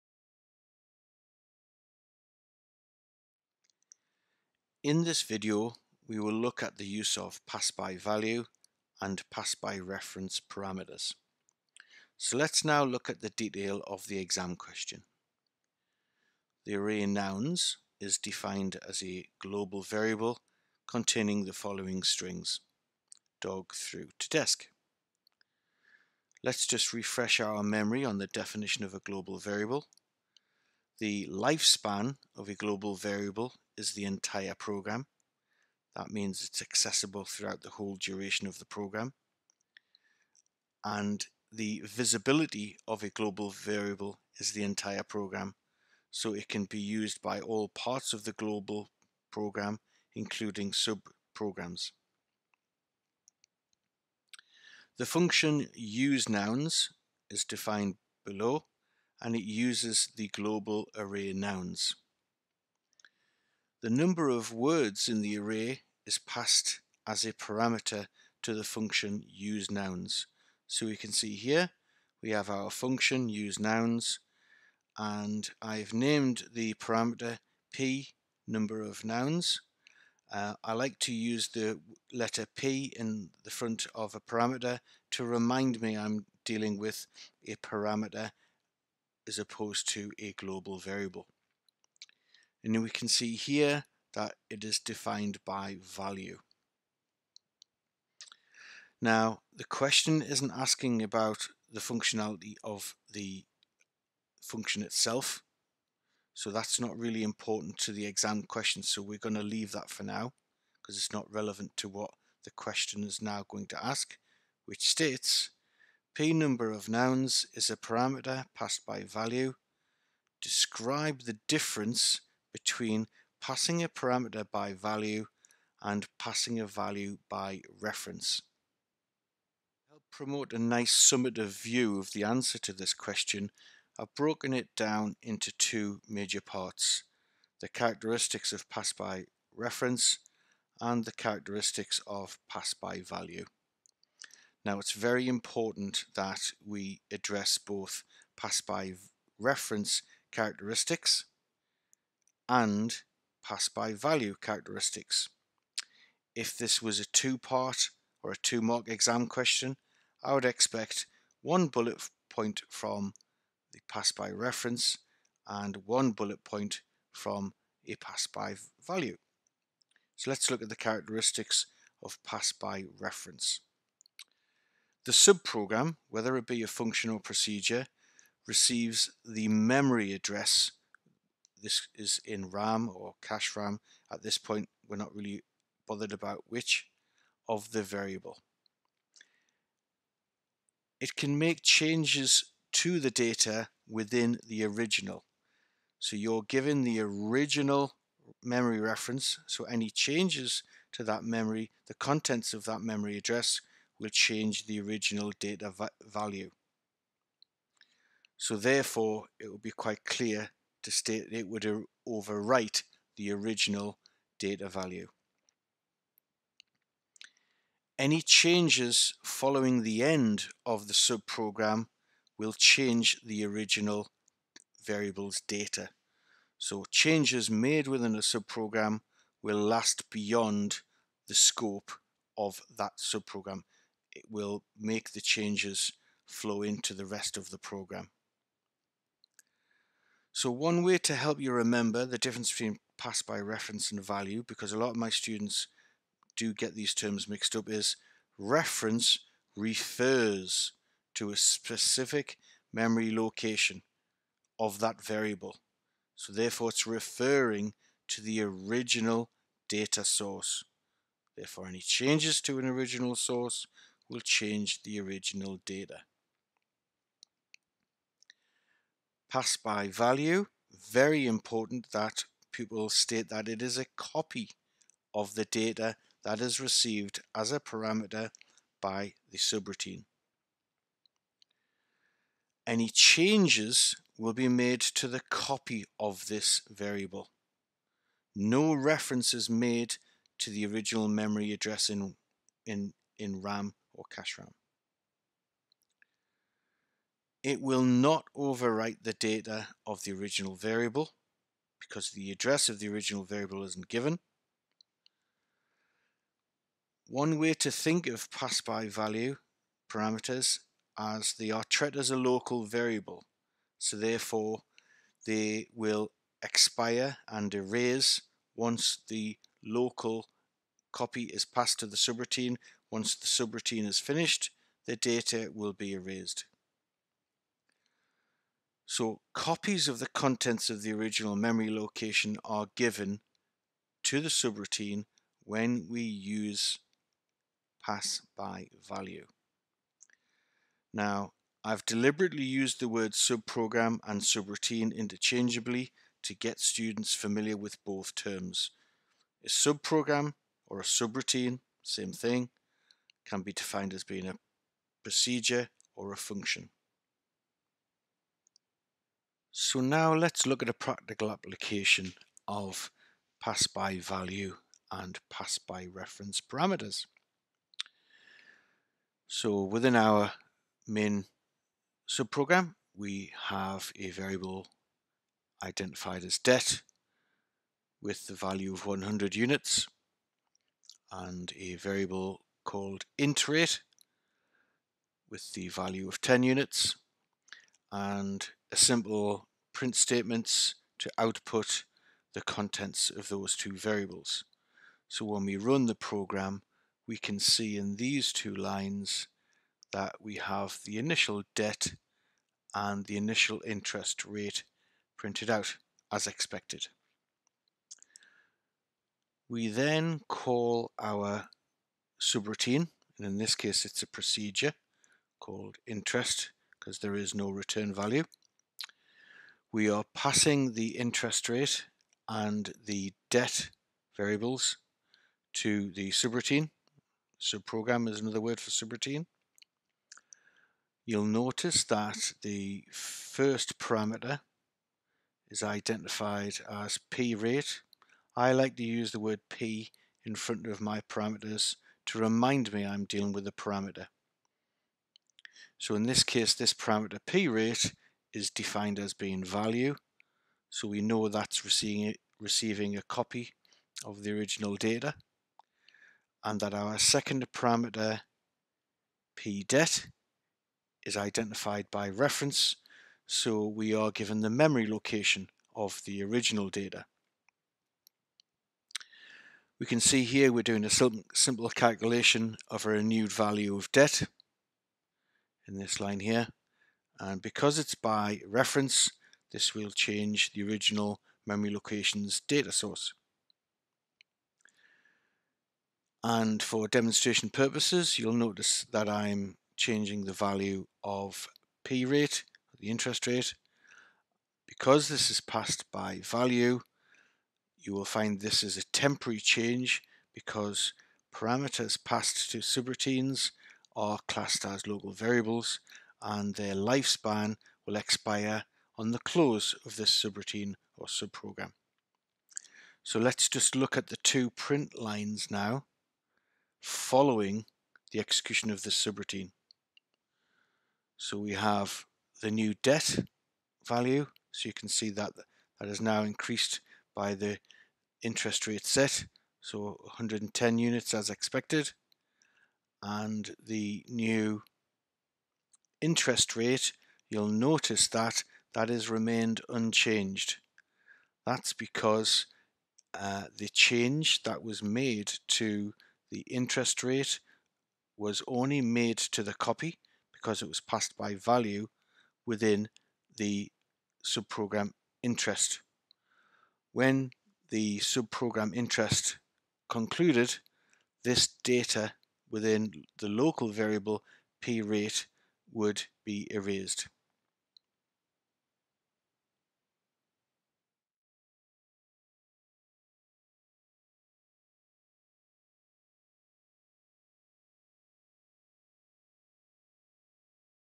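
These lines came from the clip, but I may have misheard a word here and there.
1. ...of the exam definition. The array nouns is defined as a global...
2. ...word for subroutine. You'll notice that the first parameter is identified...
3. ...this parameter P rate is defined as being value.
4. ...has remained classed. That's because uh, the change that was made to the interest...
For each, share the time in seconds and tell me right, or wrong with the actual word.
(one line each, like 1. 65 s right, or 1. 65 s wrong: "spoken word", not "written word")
1. 13 s wrong: "question", not "definition"
2. 428 s right
3. 446 s right
4. 538 s wrong: "unchanged", not "classed".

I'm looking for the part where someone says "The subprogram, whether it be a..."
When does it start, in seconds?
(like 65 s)
175 s.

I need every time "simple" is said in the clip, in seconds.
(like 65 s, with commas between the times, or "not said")
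470 s.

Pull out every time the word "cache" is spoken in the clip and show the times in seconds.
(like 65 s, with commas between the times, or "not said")
183 s, 294 s.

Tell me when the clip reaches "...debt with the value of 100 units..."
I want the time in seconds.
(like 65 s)
376 s.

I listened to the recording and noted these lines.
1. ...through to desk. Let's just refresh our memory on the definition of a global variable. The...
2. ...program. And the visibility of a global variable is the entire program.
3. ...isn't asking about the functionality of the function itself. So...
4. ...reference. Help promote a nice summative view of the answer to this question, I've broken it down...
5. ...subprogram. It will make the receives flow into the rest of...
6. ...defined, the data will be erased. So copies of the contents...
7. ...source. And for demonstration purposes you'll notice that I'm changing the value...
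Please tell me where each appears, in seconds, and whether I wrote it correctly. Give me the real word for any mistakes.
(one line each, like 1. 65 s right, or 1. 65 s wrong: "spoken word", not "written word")
1. 23 s right
2. 38 s right
3. 100 s right
4. 127 s right
5. 232 s wrong: "changes", not "receives"
6. 323 s wrong: "finished", not "defined"
7. 482 s right.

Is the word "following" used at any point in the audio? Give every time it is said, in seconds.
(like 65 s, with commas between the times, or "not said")
21 s, 219 s, 516 s.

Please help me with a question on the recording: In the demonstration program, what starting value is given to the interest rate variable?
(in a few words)
10 units.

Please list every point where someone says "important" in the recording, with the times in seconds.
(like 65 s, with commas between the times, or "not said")
107 s, 145 s, 271 s.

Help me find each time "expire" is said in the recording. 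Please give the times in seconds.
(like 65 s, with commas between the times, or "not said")
316 s, 507 s.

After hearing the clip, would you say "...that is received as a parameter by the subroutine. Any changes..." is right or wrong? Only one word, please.
right.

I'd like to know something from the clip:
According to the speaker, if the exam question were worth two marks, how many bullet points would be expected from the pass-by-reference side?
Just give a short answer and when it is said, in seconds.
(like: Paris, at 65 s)
1, at 161 s.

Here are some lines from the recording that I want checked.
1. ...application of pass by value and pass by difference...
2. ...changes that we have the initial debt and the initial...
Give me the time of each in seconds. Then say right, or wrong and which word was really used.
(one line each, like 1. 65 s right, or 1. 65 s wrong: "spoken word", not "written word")
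1. 361 s wrong: "reference", not "difference"
2. 398 s wrong: "lines", not "changes".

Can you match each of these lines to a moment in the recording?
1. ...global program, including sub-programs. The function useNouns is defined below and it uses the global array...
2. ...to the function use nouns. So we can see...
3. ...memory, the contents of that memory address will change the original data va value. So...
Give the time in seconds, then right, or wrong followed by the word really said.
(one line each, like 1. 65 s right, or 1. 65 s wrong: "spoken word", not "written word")
1. 48 s right
2. 68 s right
3. 201 s right.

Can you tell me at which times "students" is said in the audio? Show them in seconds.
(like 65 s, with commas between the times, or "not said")
245 s, 346 s.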